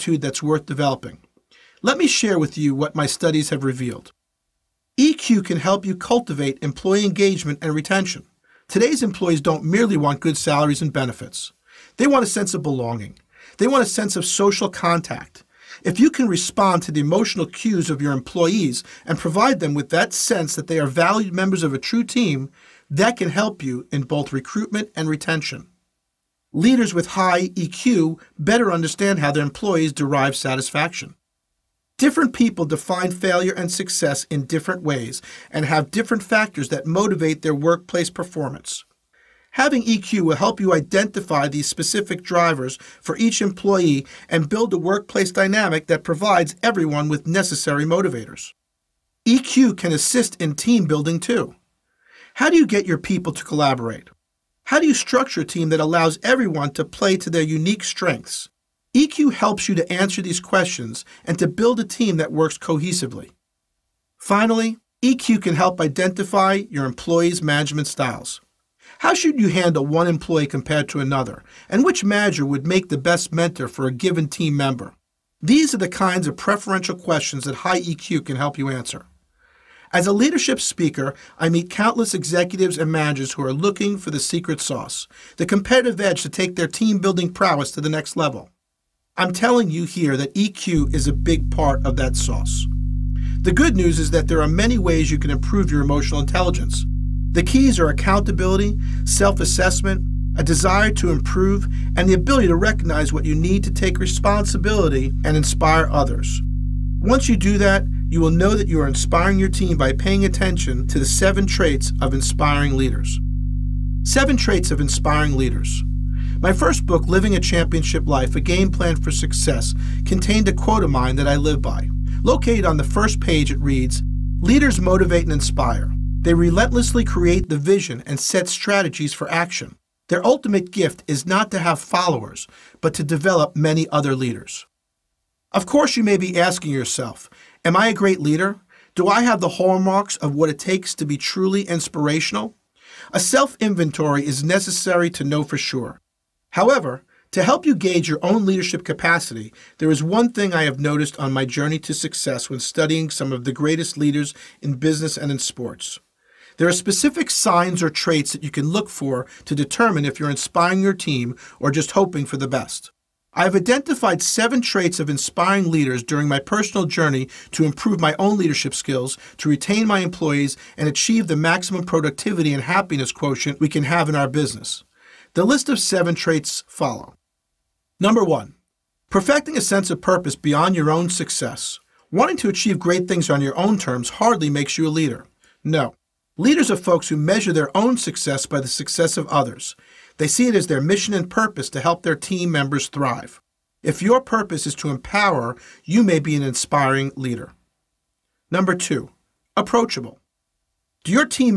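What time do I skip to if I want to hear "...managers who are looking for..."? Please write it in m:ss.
1:22.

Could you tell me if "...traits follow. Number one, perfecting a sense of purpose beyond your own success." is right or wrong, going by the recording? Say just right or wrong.
right.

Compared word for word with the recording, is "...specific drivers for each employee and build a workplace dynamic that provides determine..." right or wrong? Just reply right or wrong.
wrong.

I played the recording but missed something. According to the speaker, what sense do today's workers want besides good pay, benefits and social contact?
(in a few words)
A sense of belonging.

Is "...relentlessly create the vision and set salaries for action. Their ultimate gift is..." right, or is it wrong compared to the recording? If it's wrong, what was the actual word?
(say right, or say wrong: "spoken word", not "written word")
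wrong: "strategies", not "salaries".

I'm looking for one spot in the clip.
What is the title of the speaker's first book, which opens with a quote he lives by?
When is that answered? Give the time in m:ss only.
1:57.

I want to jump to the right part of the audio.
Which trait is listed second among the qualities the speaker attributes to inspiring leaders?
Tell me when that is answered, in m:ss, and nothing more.
3:19.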